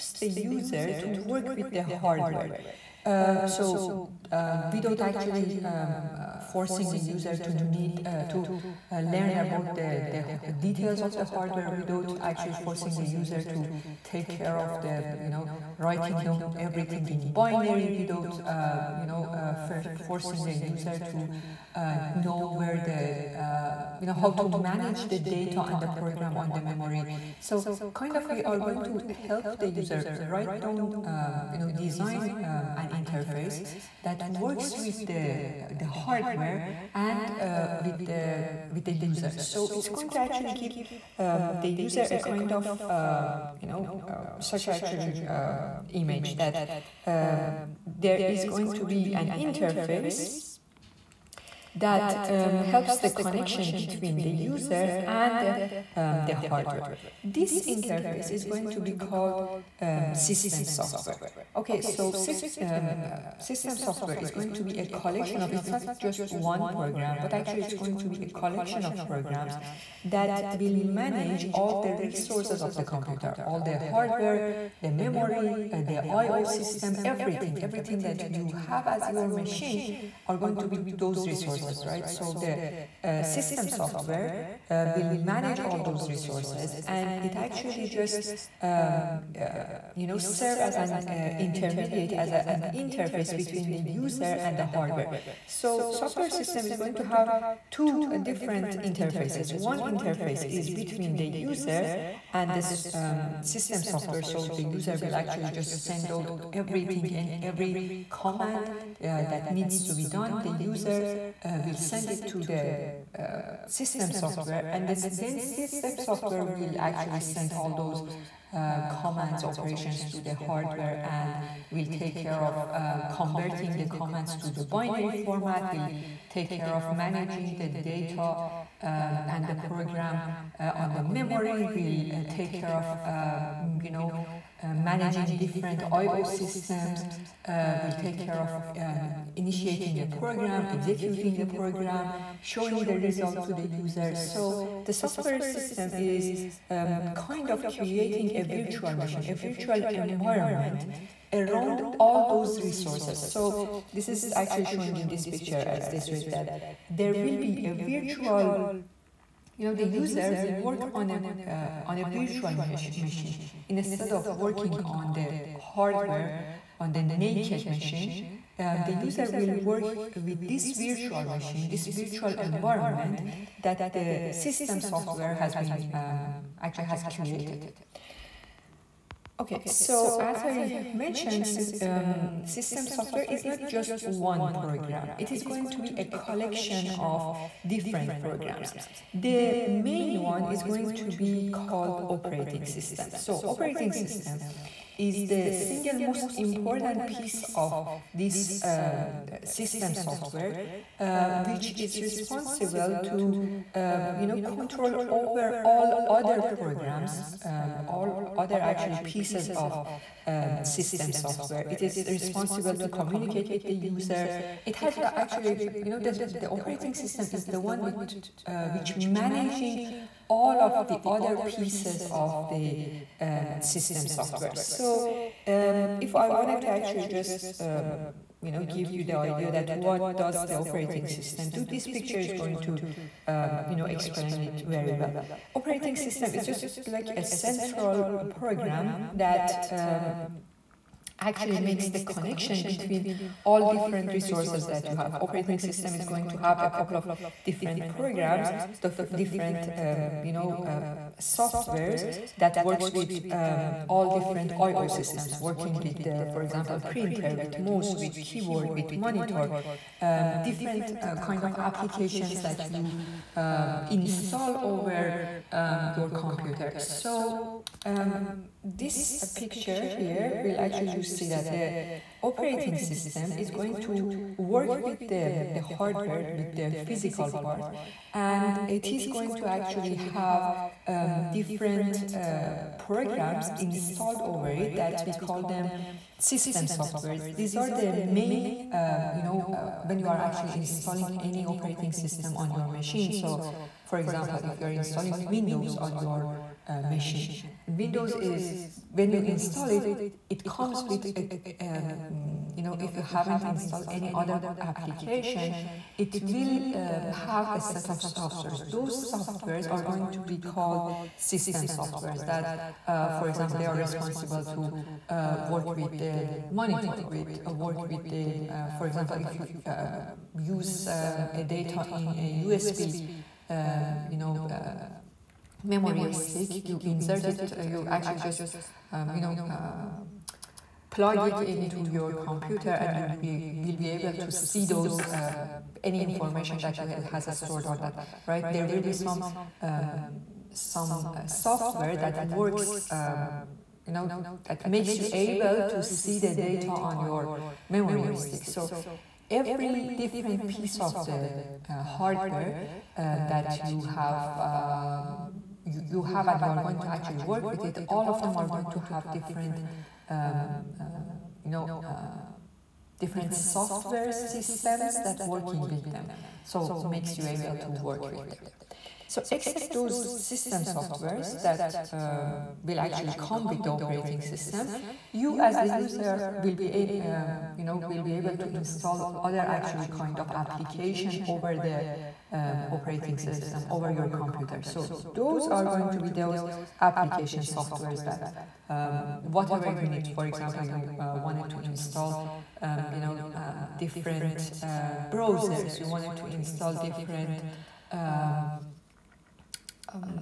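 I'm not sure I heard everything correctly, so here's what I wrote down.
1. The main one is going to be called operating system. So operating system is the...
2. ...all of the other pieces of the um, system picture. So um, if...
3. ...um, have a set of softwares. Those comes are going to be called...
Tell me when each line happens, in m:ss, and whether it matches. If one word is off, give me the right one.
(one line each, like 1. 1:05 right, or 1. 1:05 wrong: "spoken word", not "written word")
1. 3:09 right
2. 3:40 wrong: "software", not "picture"
3. 5:06 wrong: "softwares", not "comes".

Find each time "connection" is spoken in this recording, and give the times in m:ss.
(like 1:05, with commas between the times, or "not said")
0:53, 4:01.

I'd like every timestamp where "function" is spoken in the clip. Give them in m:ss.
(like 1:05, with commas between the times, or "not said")
not said.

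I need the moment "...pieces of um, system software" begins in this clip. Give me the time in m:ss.
3:28.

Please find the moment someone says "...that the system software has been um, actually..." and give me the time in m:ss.
2:53.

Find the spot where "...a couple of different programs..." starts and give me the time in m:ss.
4:06.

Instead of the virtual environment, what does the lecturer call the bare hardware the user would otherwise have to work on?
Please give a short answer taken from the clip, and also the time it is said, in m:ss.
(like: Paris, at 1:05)
The naked machine, at 2:47.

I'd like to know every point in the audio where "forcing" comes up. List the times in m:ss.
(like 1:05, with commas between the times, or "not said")
0:06, 0:12, 0:19.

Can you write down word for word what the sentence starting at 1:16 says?
system, everything, everything that you have as your machine are going to be those resources, right?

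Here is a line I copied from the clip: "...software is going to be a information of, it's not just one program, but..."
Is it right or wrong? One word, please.
wrong.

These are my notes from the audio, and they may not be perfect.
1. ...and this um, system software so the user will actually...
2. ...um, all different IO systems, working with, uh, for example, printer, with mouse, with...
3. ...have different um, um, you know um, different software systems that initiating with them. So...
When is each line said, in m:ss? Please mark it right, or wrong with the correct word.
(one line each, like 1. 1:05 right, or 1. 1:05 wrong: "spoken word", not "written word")
1. 1:42 right
2. 4:13 right
3. 5:58 wrong: "working", not "initiating".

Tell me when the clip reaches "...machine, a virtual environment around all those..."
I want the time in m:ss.
2:29.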